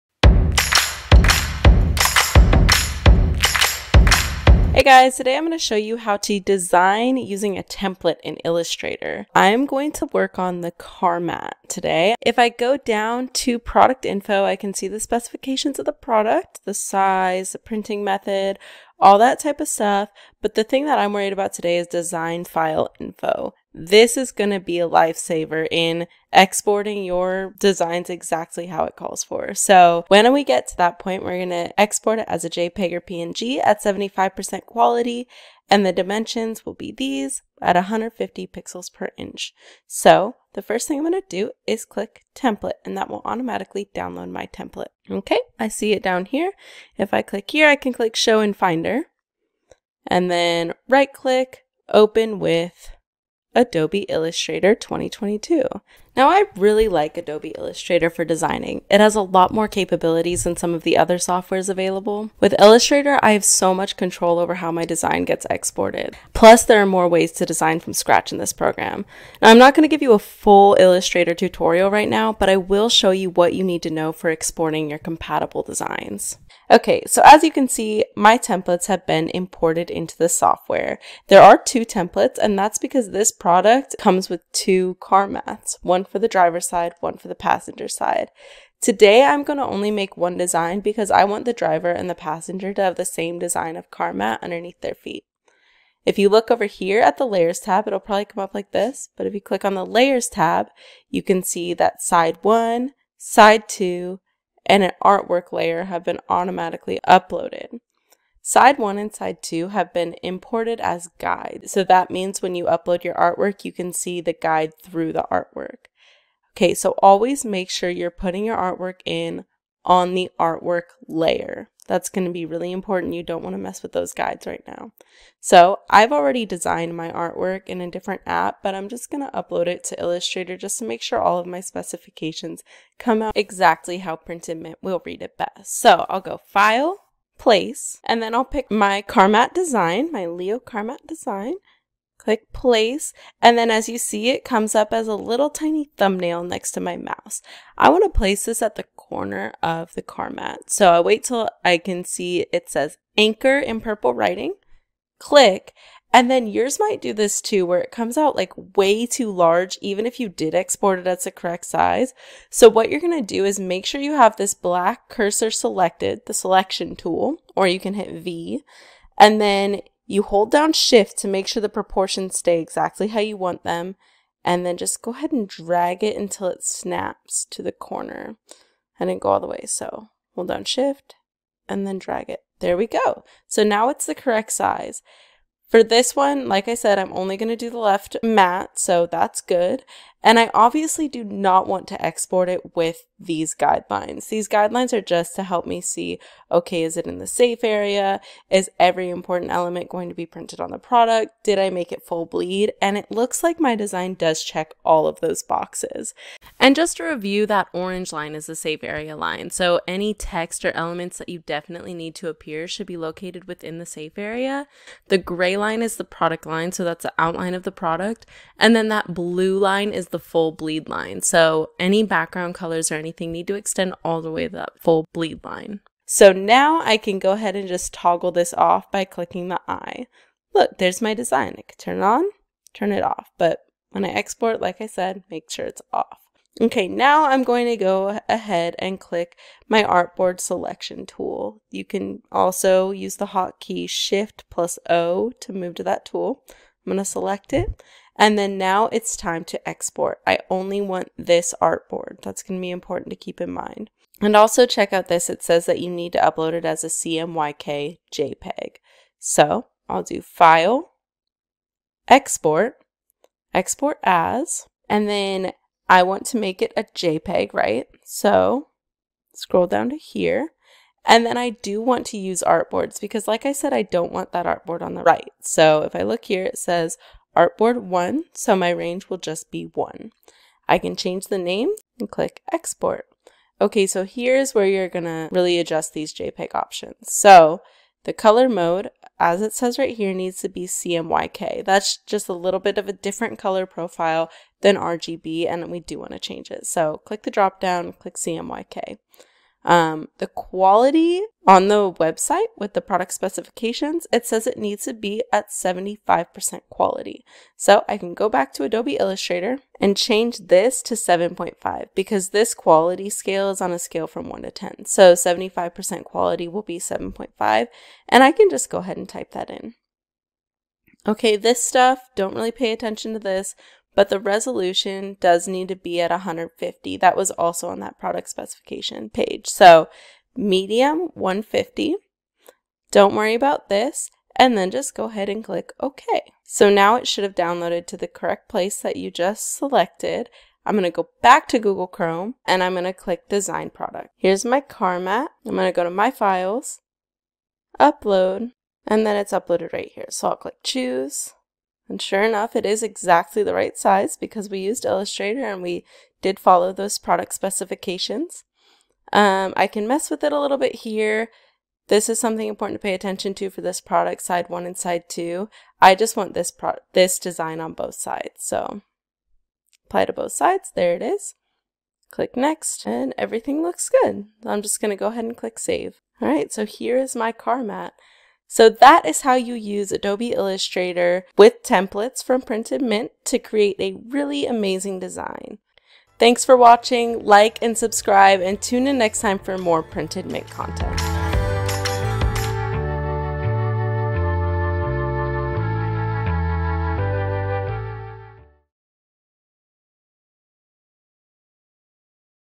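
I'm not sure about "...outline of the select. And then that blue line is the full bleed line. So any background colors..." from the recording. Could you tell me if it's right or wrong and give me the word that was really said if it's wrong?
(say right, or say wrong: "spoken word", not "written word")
wrong: "product", not "select".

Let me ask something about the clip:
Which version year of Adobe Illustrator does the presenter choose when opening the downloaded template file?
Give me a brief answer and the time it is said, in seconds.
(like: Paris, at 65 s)
2022, at 53 s.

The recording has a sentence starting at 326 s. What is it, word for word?
That was also on that product specification page.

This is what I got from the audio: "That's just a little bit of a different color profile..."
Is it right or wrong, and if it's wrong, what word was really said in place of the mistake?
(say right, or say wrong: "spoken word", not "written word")
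right.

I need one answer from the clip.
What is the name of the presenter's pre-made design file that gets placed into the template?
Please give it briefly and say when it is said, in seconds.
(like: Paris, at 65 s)
Leo Carmat, at 140 s.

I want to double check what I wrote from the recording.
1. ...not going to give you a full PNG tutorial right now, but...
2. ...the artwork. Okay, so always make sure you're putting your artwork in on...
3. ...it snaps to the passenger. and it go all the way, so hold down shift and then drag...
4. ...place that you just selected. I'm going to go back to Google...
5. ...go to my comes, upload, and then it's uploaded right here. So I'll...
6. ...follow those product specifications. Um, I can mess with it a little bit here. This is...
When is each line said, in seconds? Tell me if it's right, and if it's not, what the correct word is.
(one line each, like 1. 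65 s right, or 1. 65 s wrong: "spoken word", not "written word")
1. 69 s wrong: "Illustrator", not "PNG"
2. 115 s right
3. 176 s wrong: "corner", not "passenger"
4. 338 s right
5. 345 s wrong: "files", not "comes"
6. 356 s right.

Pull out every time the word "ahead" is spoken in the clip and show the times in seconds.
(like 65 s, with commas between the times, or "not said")
175 s, 227 s, 238 s, 318 s, 335 s, 375 s.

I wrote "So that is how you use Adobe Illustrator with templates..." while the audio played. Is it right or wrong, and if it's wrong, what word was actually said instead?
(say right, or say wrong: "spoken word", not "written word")
right.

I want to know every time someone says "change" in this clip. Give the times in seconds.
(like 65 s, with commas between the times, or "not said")
280 s, 296 s, 309 s.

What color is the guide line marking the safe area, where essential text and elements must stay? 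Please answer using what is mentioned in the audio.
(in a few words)
orange.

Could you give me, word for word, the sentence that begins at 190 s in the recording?
And I obviously do not want to export it with these guidelines.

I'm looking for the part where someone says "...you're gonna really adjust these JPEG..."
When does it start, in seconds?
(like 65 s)
284 s.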